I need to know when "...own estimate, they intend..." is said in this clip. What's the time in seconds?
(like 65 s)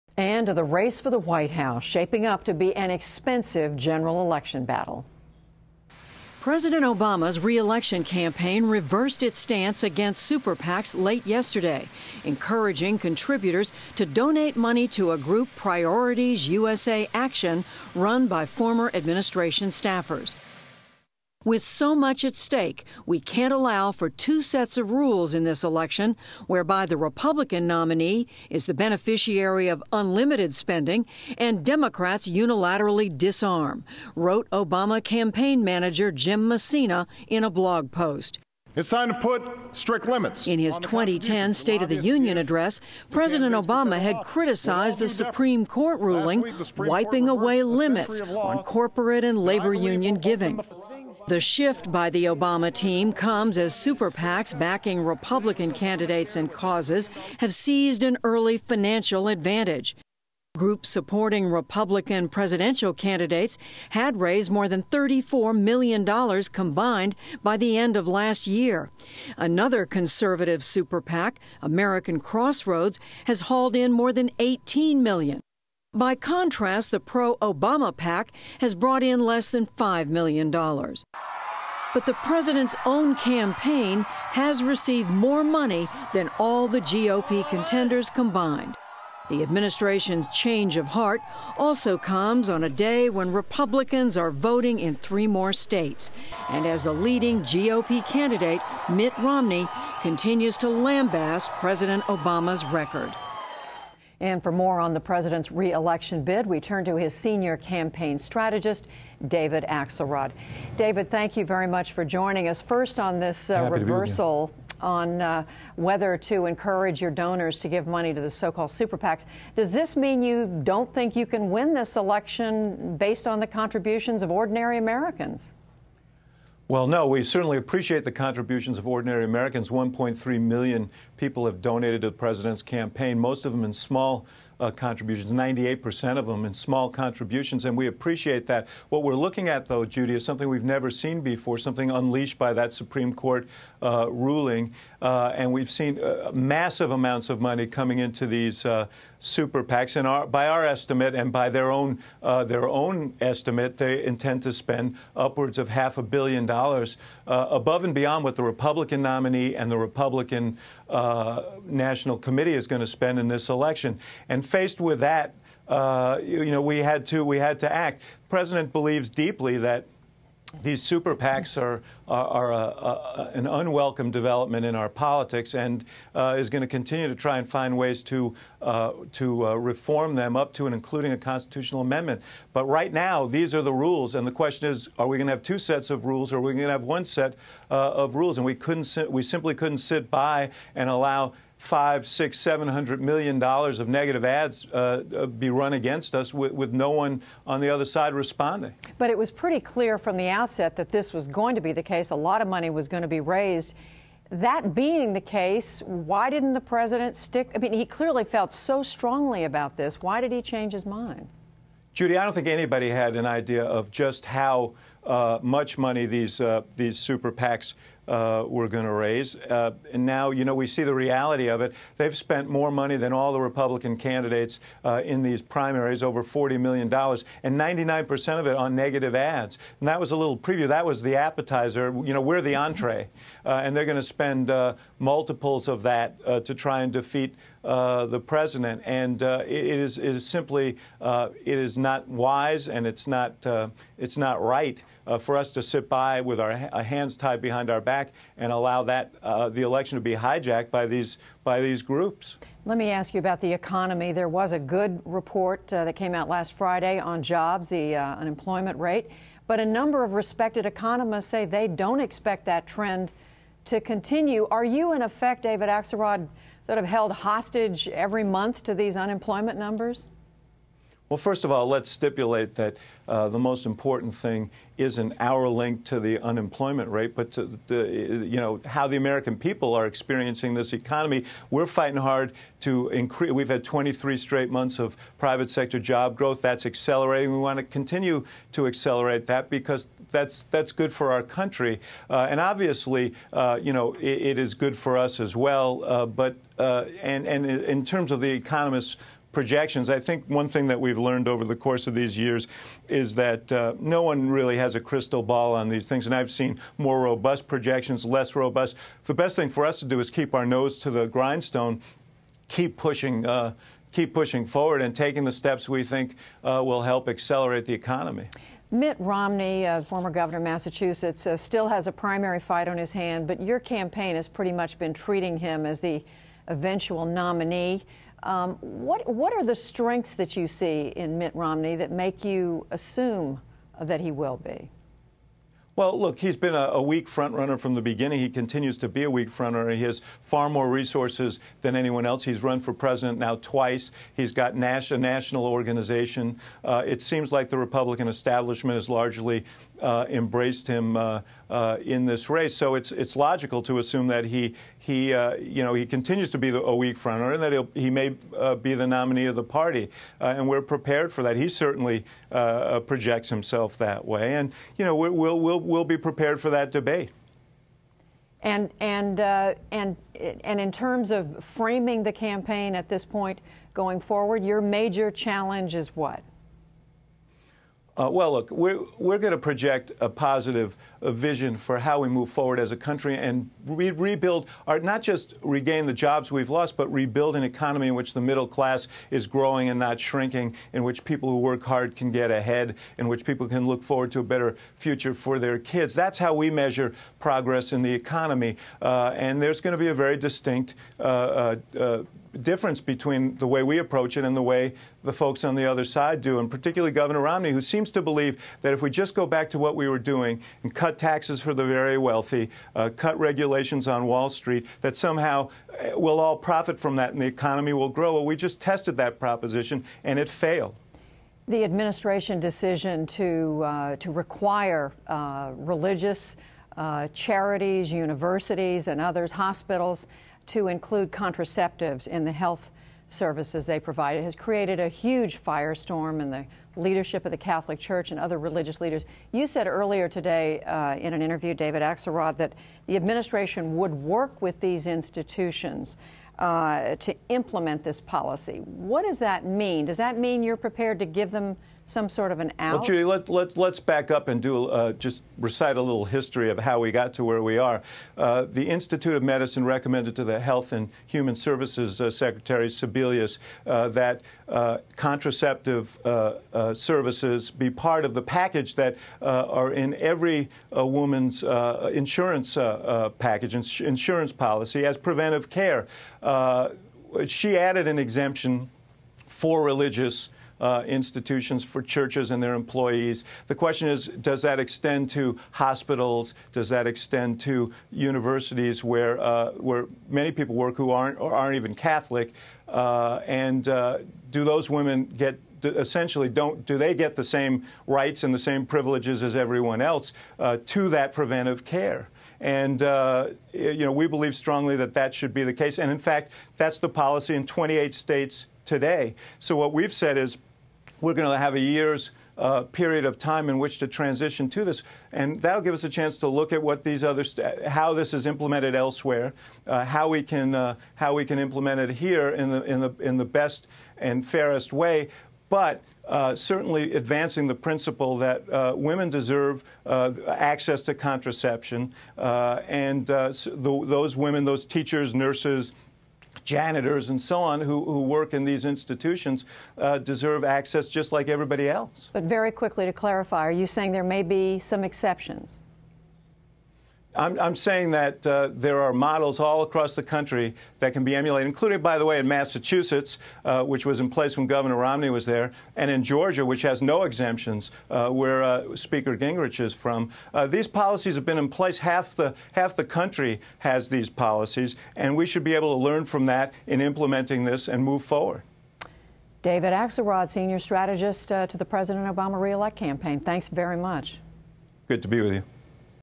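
152 s.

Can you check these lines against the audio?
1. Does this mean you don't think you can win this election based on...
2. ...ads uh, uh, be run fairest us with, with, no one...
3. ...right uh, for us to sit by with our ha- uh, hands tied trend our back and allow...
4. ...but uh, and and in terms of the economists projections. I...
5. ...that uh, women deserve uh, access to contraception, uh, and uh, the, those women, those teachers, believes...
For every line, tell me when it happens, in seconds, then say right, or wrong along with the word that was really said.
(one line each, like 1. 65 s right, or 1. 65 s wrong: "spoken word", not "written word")
1. 119 s right
2. 194 s wrong: "against", not "fairest"
3. 244 s wrong: "behind", not "trend"
4. 296 s right
5. 528 s wrong: "nurses", not "believes".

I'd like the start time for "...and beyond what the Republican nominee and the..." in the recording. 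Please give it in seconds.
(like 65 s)
157 s.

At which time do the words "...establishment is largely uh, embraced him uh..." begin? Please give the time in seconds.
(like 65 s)
348 s.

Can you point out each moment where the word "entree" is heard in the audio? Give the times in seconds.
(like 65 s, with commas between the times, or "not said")
232 s.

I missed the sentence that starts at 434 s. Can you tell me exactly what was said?
It has created a huge firestorm in the leadership of the Catholic Church and other religious leaders.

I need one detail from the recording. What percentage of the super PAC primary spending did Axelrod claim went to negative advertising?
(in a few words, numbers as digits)
99%.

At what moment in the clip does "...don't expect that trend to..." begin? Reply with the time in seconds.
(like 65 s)
261 s.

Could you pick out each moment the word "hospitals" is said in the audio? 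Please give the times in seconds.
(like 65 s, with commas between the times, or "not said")
429 s, 485 s.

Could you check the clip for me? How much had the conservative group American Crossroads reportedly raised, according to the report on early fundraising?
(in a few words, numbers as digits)
more than $18 million.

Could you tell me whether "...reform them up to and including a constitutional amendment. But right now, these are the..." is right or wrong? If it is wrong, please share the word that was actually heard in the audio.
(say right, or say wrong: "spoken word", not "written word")
right.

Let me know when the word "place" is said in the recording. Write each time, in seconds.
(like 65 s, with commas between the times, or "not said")
554 s, 561 s.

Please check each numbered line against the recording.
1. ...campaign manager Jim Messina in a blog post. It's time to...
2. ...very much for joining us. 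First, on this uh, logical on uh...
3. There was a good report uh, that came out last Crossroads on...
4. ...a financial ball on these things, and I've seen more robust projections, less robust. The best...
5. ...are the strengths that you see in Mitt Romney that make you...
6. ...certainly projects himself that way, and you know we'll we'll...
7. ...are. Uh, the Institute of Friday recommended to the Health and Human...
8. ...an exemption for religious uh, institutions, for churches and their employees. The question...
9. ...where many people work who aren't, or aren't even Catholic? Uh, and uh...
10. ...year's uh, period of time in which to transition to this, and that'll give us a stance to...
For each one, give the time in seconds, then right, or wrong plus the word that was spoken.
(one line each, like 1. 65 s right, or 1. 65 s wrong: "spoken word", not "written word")
1. 35 s right
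2. 111 s wrong: "reversal", not "logical"
3. 254 s wrong: "Friday", not "Crossroads"
4. 304 s wrong: "crystal", not "financial"
5. 329 s right
6. 361 s right
7. 457 s wrong: "Medicine", not "Friday"
8. 477 s right
9. 489 s right
10. 511 s wrong: "chance", not "stance".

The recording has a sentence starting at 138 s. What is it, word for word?
What we're looking at, though, Judy, is something we've never seen before, something unleashed by that Supreme Court uh, ruling.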